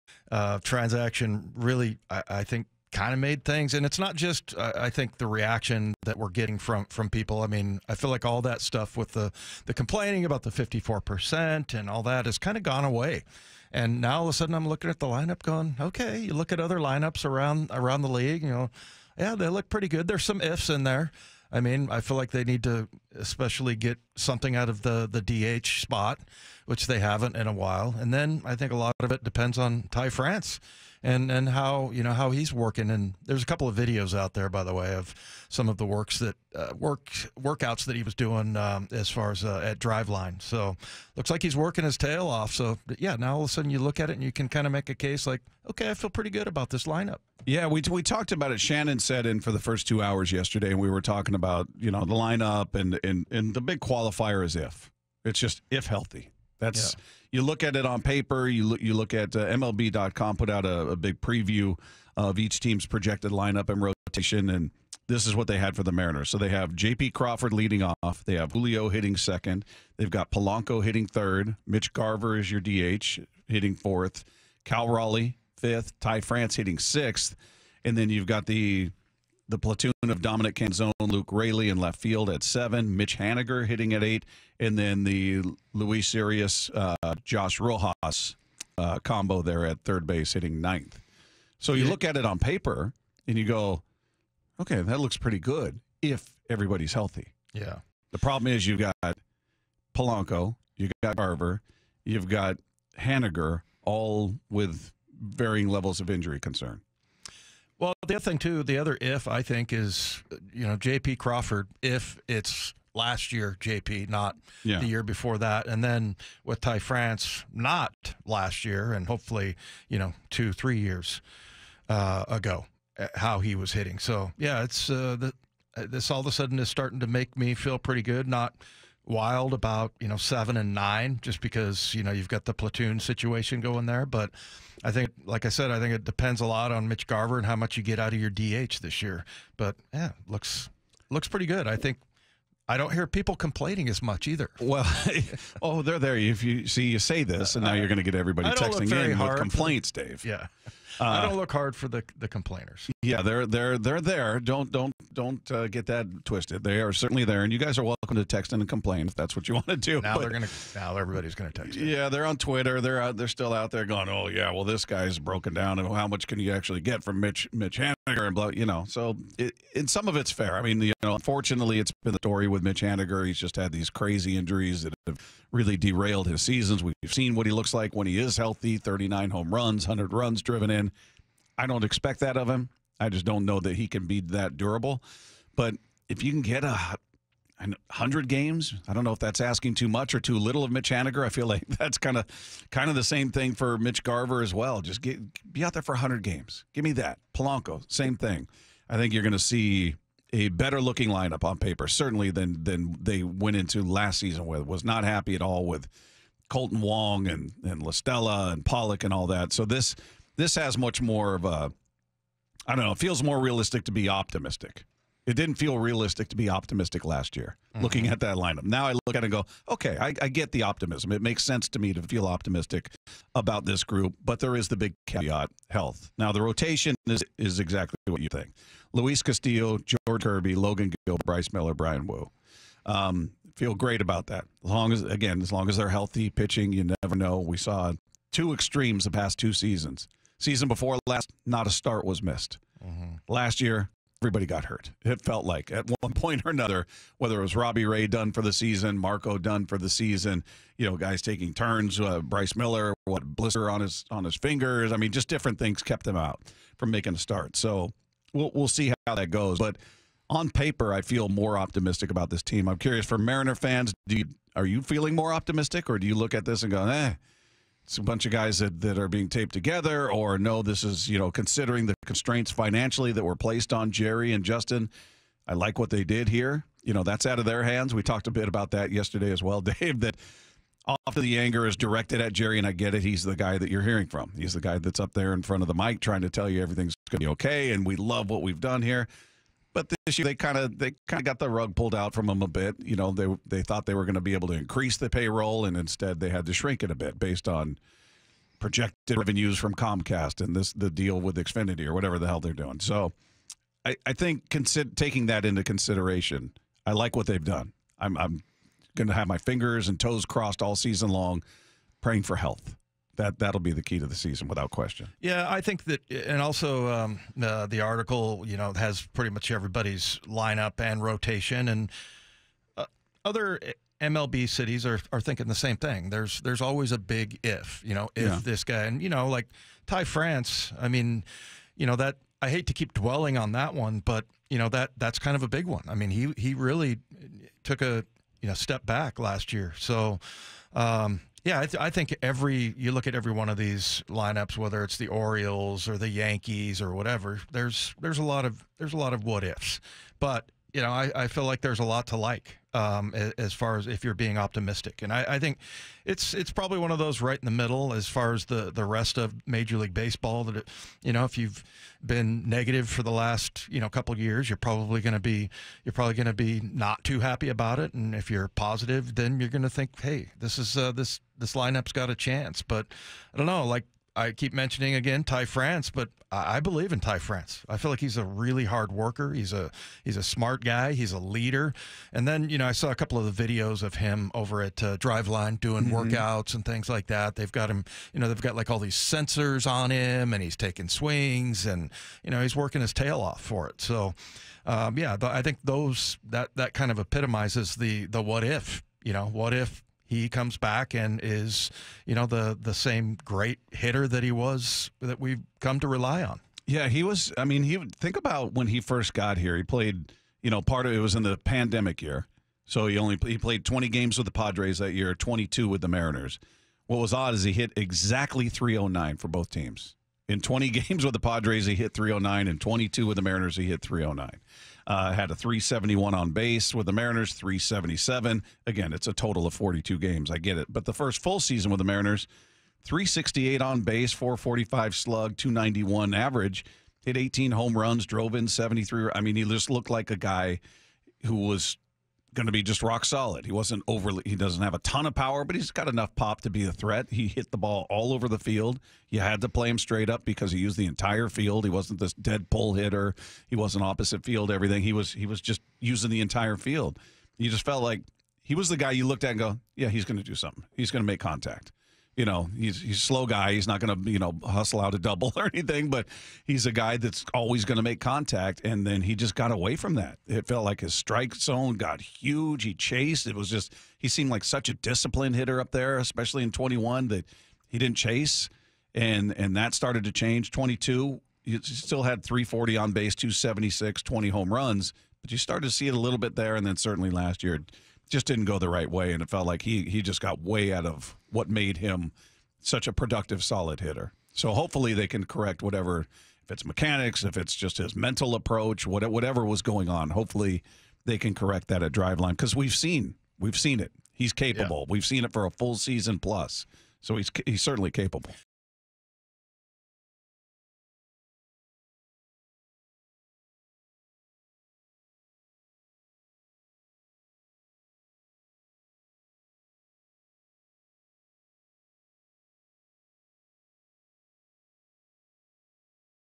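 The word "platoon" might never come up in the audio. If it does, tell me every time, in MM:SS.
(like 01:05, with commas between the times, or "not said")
01:19, 02:12.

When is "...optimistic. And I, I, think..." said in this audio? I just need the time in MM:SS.
05:54.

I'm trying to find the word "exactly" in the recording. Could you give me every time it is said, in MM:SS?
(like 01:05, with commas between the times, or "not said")
03:47, 06:57.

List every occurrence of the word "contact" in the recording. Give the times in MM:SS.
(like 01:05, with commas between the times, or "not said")
07:41, 07:47.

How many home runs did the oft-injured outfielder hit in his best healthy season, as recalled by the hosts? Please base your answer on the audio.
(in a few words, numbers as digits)
39.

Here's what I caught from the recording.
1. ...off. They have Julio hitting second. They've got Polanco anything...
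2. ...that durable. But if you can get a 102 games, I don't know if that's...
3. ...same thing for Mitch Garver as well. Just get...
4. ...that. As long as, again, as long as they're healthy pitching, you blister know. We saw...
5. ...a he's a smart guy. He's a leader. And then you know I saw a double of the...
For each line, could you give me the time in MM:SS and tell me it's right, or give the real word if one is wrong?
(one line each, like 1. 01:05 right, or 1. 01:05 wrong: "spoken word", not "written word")
1. 01:07 wrong: "hitting", not "anything"
2. 03:04 wrong: "100", not "102"
3. 03:13 right
4. 03:54 wrong: "never", not "blister"
5. 06:19 wrong: "couple", not "double".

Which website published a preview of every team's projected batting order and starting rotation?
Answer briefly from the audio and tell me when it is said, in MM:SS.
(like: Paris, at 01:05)
MLB.com, at 00:59.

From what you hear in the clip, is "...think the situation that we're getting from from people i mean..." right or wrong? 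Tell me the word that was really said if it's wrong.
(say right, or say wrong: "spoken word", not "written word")
wrong: "reaction", not "situation".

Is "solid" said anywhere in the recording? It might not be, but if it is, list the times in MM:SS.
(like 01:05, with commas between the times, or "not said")
07:23, 08:13.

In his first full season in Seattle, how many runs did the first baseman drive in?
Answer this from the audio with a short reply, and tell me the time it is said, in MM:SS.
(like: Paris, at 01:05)
73, at 07:18.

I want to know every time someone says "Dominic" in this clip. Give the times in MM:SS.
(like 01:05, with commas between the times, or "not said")
01:20.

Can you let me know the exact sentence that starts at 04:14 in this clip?
I mean, just different things kept them out from making a start.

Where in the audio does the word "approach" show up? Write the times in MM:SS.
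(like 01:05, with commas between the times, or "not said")
08:18.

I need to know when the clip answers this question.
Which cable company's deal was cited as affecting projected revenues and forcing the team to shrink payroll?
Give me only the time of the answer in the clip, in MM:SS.
04:59.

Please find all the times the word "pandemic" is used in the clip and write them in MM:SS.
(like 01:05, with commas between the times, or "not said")
06:51.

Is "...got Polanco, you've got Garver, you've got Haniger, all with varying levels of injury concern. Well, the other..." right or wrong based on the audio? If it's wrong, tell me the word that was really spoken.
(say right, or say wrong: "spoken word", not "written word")
right.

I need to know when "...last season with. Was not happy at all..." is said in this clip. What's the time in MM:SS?
03:23.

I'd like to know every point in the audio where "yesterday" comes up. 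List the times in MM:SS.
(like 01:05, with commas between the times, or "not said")
00:50, 04:38.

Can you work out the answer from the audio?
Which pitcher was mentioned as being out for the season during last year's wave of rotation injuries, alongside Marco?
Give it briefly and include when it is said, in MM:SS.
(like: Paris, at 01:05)
Robbie Ray, at 04:07.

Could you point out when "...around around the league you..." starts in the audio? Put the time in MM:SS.
00:17.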